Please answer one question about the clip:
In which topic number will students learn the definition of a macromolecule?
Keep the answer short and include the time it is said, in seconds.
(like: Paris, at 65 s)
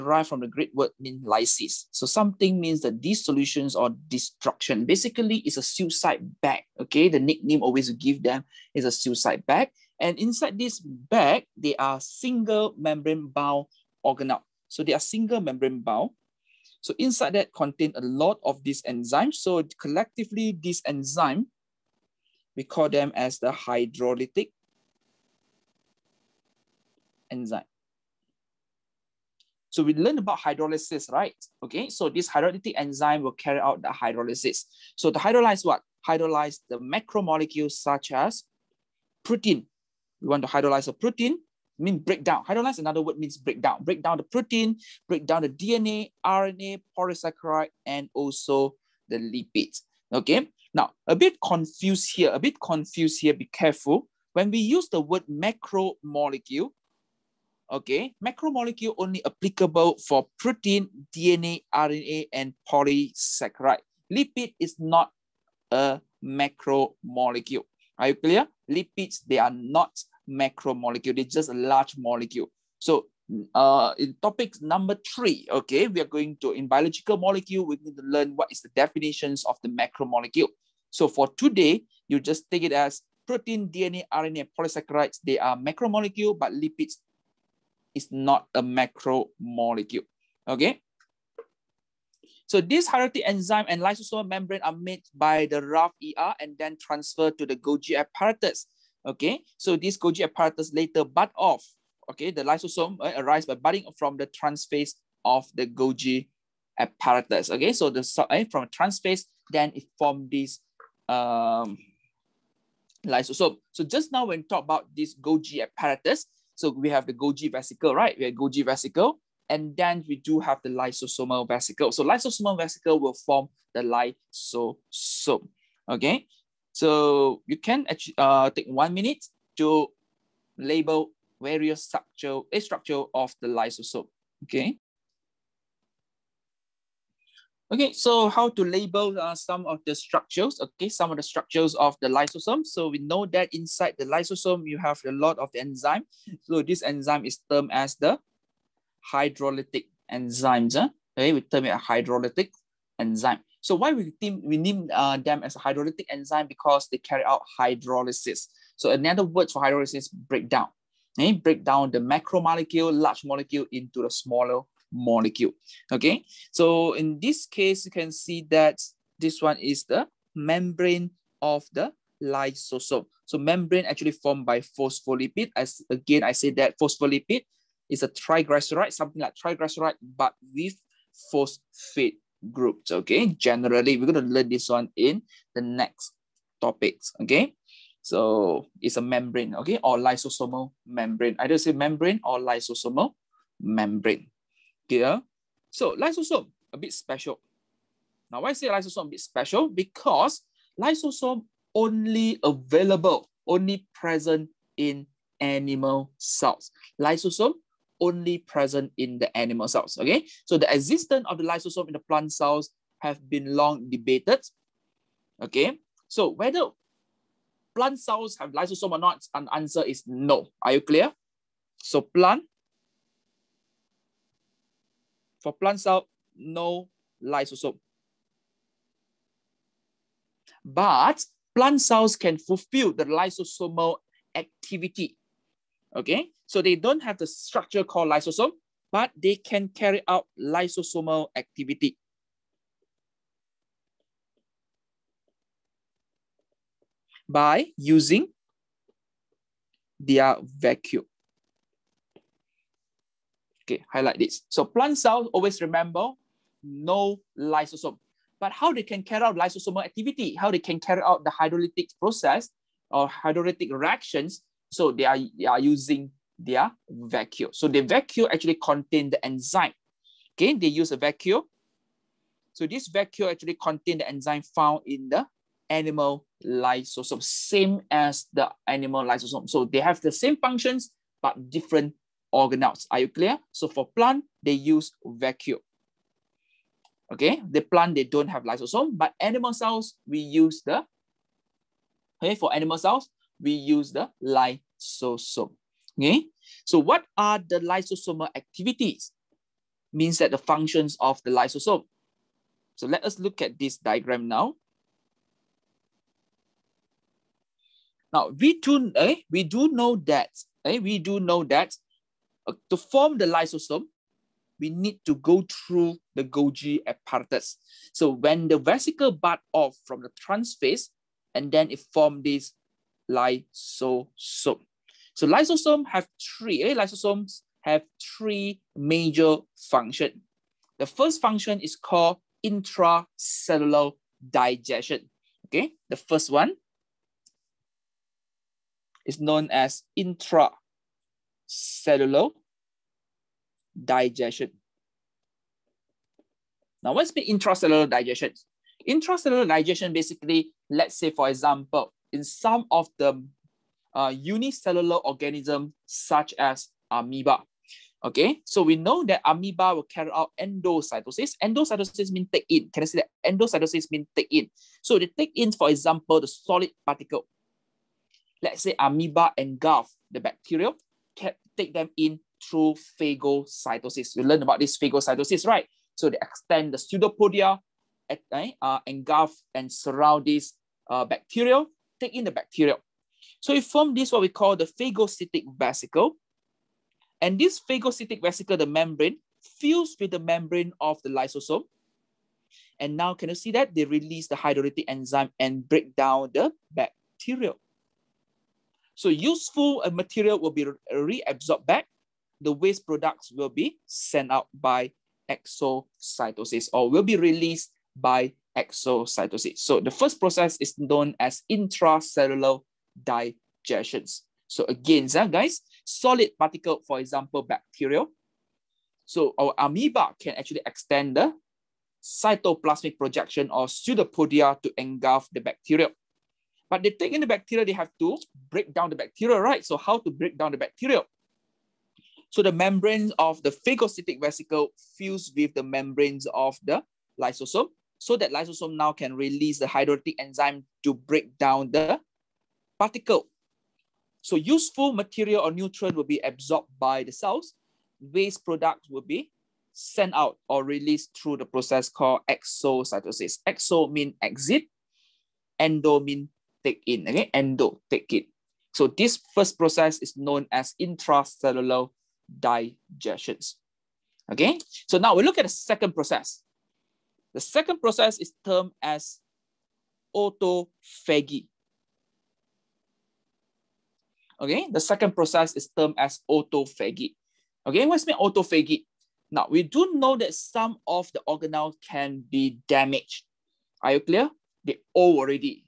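3, at 74 s.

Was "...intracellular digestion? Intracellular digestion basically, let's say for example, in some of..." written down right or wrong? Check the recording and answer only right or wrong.
right.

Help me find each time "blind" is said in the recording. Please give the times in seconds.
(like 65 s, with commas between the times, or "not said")
not said.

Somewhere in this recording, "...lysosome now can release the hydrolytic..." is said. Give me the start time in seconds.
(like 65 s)
438 s.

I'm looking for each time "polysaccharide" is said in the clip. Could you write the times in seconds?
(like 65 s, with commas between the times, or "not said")
46 s, 62 s, 84 s.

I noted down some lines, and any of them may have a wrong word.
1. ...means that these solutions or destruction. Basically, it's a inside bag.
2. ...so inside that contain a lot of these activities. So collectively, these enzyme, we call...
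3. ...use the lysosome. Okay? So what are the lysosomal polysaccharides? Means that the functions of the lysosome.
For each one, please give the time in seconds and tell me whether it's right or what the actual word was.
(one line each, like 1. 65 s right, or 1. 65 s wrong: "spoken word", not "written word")
1. 2 s wrong: "suicide", not "inside"
2. 16 s wrong: "enzymes", not "activities"
3. 293 s wrong: "activities", not "polysaccharides".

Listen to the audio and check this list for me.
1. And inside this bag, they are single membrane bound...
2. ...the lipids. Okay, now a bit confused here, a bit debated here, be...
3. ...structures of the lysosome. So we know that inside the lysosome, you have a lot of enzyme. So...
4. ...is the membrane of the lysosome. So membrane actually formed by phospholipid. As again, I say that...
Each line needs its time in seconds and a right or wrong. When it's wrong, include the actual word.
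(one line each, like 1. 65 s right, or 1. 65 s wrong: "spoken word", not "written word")
1. 9 s right
2. 49 s wrong: "confused", not "debated"
3. 141 s right
4. 169 s right.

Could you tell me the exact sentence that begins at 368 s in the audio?
Let's say amoeba engulf the bacteria, take them in through phagocytosis.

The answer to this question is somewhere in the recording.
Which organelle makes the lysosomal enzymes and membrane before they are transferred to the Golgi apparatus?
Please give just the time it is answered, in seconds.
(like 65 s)
95 s.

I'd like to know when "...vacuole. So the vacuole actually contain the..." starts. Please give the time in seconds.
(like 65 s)
266 s.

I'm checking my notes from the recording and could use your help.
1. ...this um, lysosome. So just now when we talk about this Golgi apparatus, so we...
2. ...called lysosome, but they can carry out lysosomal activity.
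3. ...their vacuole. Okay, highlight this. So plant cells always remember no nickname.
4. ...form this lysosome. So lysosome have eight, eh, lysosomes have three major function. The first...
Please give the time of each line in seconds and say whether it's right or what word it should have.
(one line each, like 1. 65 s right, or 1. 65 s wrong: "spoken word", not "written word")
1. 110 s right
2. 237 s right
3. 249 s wrong: "lysosome", not "nickname"
4. 321 s wrong: "three", not "eight".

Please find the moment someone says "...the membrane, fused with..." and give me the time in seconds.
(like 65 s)
388 s.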